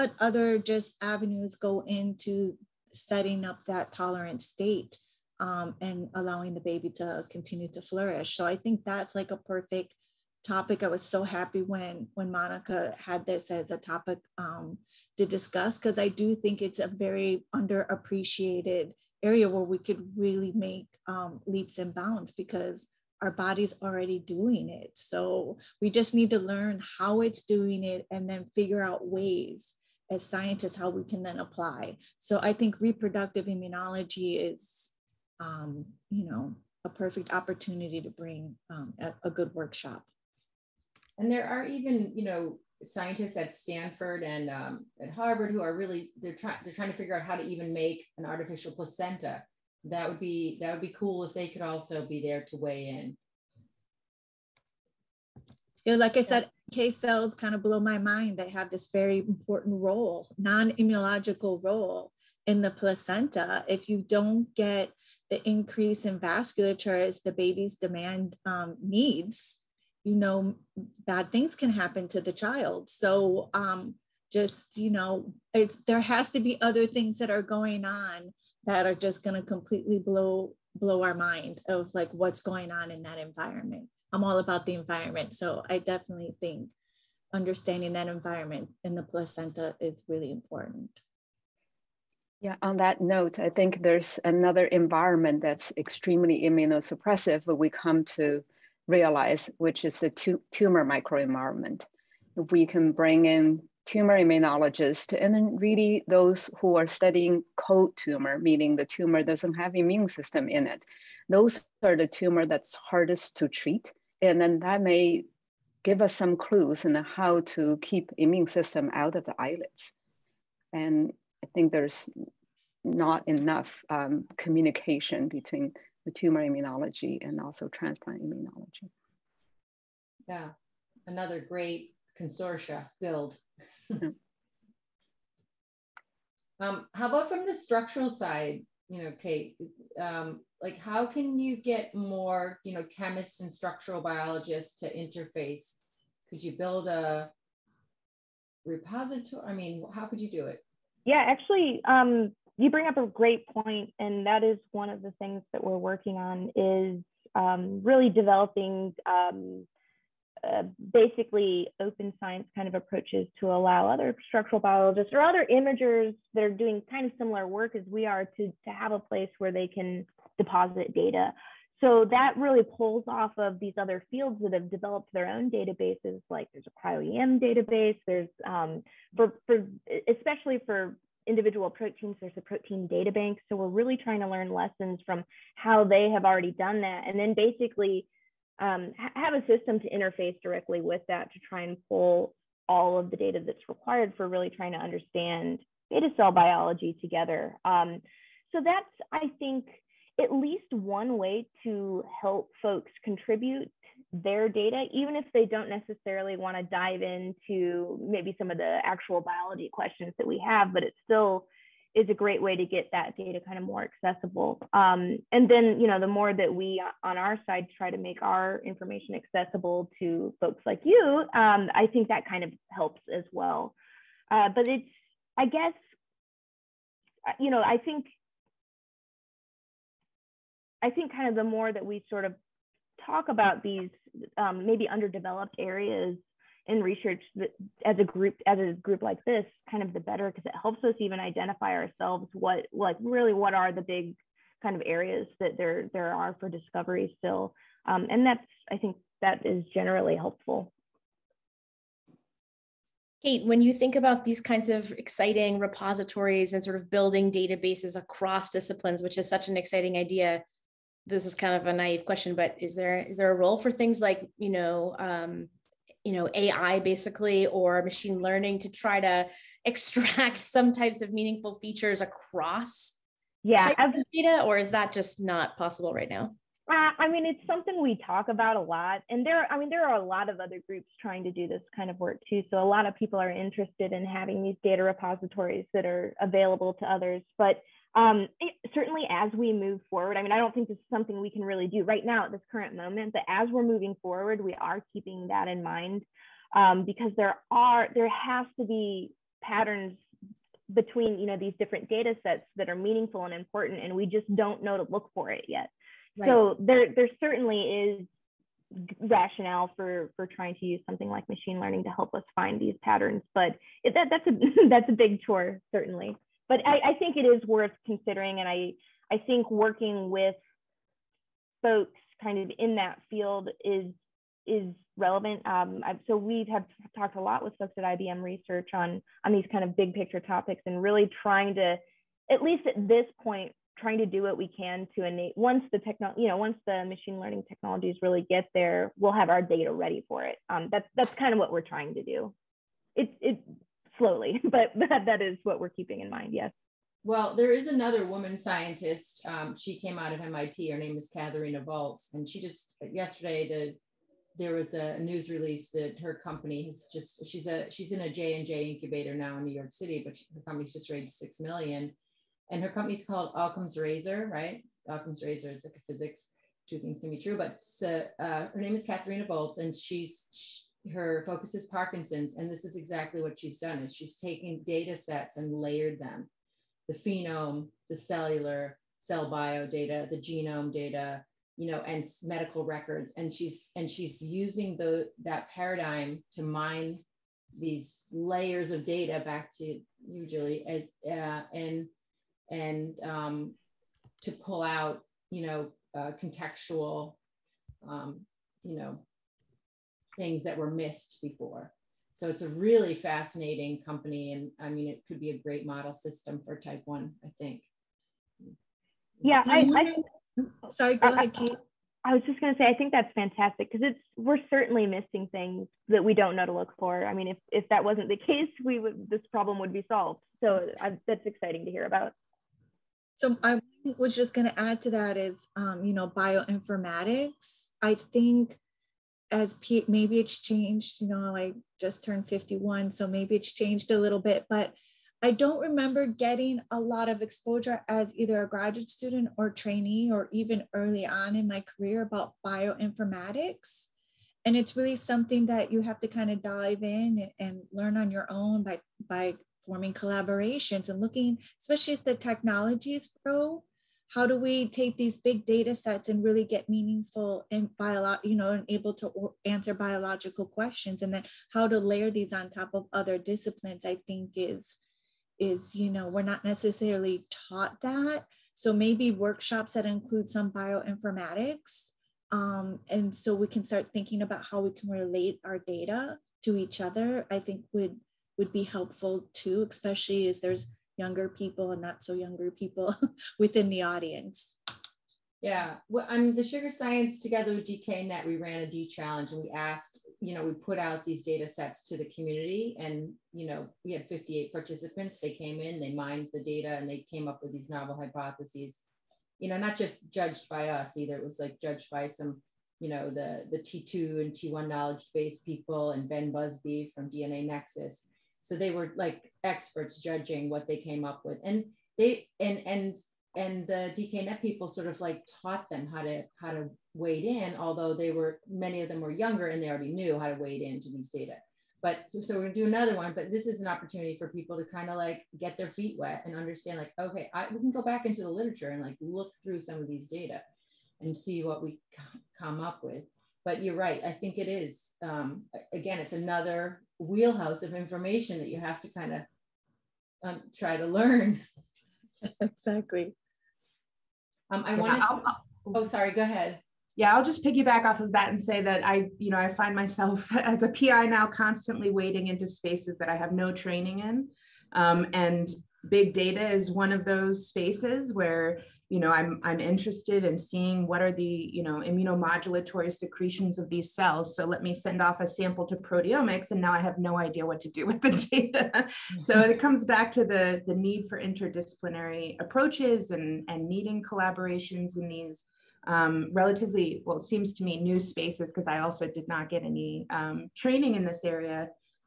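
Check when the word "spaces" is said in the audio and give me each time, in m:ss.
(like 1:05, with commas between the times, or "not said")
9:12, 9:17, 9:37.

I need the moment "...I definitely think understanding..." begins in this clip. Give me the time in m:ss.
1:25.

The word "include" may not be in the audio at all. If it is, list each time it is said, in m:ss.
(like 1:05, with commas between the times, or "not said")
7:49.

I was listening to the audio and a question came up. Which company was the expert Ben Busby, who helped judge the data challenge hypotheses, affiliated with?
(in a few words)
DNAnexus.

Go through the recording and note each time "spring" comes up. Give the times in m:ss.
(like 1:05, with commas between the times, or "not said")
not said.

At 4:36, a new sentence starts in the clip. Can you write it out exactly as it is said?
Uh, I mean, it's something we talk about a lot, and there.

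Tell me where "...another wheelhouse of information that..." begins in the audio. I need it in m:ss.
8:56.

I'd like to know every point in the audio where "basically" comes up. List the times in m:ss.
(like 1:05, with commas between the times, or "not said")
2:40, 3:07, 4:26.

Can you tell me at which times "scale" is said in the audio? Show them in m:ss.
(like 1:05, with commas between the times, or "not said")
not said.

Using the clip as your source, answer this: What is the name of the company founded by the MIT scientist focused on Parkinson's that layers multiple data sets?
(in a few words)
OccamzRazor.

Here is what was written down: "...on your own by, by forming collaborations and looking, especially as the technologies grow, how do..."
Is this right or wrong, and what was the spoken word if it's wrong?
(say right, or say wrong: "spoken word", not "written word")
right.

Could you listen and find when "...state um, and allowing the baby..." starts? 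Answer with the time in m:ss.
0:04.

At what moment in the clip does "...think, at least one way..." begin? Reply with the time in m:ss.
3:19.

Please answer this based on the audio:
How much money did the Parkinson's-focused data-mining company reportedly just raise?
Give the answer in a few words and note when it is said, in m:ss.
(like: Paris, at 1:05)
6 million, at 6:01.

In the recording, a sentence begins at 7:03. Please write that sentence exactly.
So I was just going to add to that is, um, you know, bioinformatics.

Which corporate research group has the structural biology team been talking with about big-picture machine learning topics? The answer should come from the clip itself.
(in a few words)
IBM Research.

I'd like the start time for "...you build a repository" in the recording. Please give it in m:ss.
2:26.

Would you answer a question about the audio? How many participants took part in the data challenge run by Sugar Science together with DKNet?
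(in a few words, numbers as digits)
58.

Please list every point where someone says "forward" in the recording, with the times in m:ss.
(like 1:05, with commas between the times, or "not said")
4:49, 4:54.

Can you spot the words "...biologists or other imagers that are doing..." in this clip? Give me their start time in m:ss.
2:44.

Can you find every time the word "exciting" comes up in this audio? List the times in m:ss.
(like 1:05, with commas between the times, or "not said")
4:14, 4:19, 7:01.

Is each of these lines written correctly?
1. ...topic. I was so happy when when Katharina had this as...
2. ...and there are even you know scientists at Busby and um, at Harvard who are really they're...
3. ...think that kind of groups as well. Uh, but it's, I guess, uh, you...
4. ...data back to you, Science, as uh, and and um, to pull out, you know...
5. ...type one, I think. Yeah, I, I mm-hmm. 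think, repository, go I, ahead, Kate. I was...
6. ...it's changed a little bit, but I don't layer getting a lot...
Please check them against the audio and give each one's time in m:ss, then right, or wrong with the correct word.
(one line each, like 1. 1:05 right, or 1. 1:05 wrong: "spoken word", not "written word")
1. 0:10 wrong: "Monica", not "Katharina"
2. 0:41 wrong: "Stanford", not "Busby"
3. 3:41 wrong: "helps", not "groups"
4. 6:28 wrong: "Julie", not "Science"
5. 6:46 wrong: "sorry", not "repository"
6. 7:13 wrong: "remember", not "layer".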